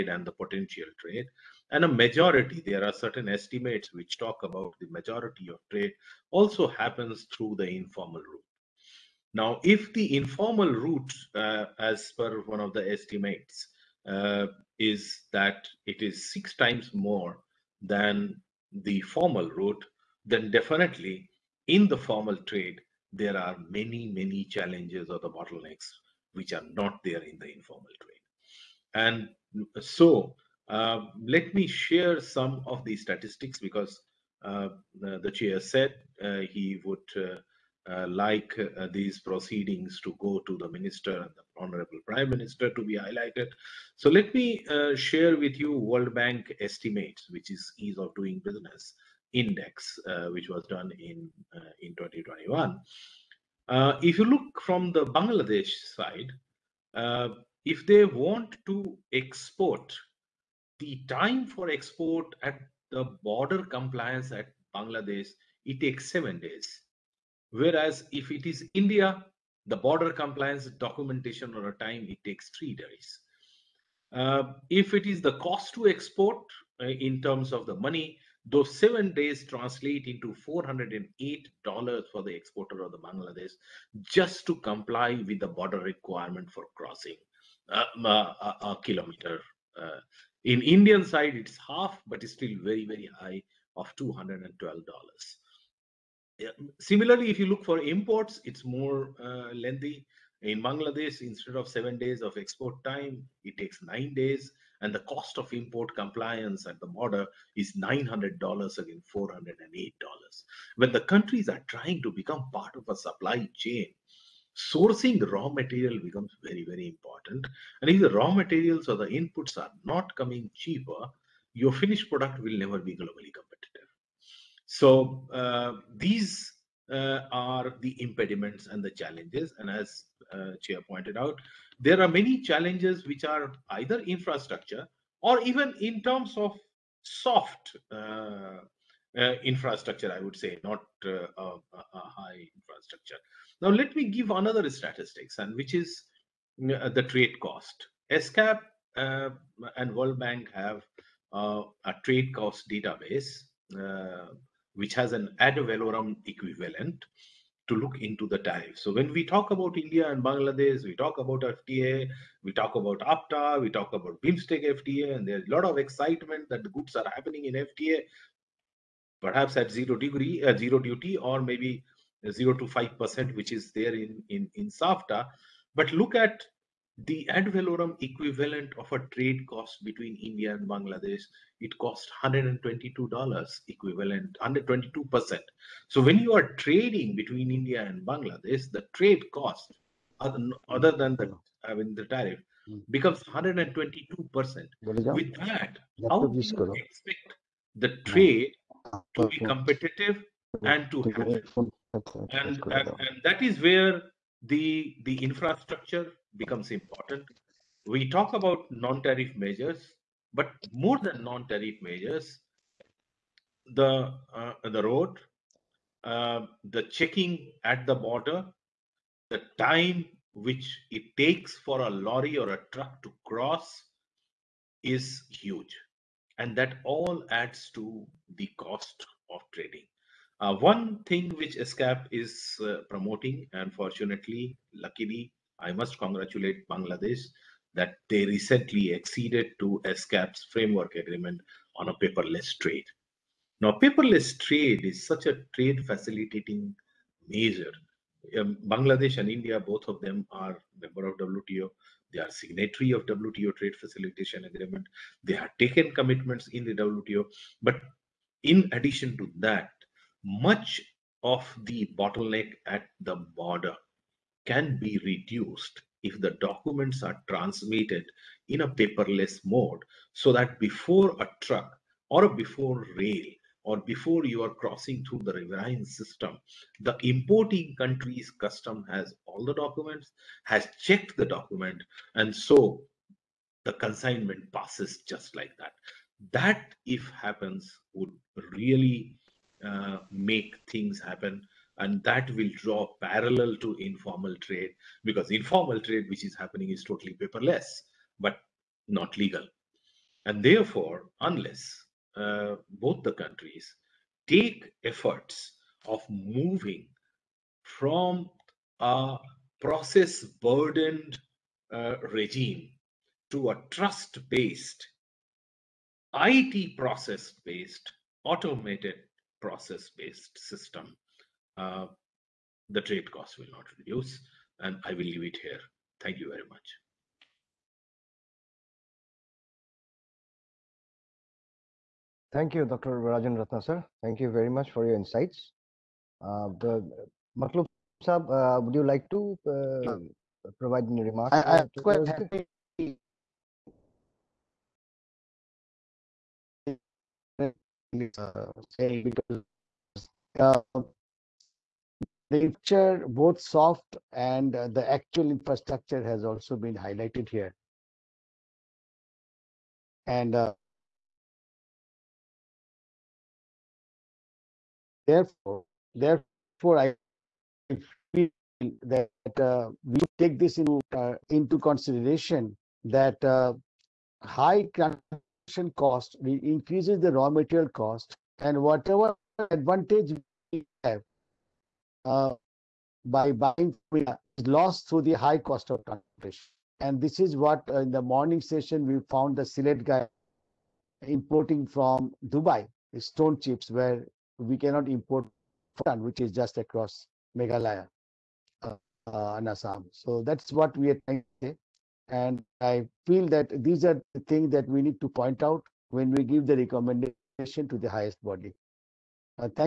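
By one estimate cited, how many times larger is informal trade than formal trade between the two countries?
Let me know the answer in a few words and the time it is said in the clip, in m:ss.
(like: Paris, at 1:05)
6, at 0:16.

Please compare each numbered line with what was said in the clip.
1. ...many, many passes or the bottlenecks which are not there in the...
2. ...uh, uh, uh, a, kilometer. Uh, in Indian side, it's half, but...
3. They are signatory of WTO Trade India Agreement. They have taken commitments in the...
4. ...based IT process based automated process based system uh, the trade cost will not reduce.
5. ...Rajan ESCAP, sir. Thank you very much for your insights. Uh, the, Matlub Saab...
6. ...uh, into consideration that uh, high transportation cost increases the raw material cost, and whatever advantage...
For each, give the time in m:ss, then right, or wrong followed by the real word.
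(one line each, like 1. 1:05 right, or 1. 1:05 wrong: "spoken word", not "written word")
1. 0:23 wrong: "challenges", not "passes"
2. 1:27 right
3. 4:12 wrong: "Facilitation", not "India"
4. 5:14 right
5. 5:32 wrong: "Ratna", not "ESCAP"
6. 6:10 right.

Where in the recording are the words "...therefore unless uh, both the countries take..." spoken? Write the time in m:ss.
5:00.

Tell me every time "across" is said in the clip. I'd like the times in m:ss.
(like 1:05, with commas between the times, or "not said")
6:36.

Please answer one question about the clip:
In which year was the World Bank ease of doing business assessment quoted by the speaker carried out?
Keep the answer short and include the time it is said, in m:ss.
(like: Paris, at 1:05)
2021, at 0:51.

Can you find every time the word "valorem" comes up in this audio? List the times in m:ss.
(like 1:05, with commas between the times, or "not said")
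2:35, 2:57.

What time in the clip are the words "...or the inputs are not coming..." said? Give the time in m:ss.
1:58.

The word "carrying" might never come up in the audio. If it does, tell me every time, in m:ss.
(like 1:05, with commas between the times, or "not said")
not said.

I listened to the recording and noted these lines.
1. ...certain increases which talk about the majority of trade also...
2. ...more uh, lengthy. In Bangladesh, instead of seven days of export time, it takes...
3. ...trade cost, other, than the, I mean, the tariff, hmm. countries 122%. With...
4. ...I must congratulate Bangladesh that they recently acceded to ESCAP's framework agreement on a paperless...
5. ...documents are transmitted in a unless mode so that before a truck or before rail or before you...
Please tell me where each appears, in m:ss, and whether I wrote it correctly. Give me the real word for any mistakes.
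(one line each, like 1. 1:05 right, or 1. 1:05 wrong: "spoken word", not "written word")
1. 0:02 wrong: "estimates", not "increases"
2. 1:38 right
3. 3:08 wrong: "becomes", not "countries"
4. 3:55 right
5. 4:26 wrong: "paperless", not "unless".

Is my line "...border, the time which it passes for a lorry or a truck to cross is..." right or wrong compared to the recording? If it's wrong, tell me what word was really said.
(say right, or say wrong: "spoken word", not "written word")
wrong: "takes", not "passes".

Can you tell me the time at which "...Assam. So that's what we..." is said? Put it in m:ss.
6:39.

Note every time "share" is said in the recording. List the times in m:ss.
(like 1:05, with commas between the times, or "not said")
0:31, 0:44.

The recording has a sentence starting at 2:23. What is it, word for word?
Now, let me give another statistics, and which is the trade cost.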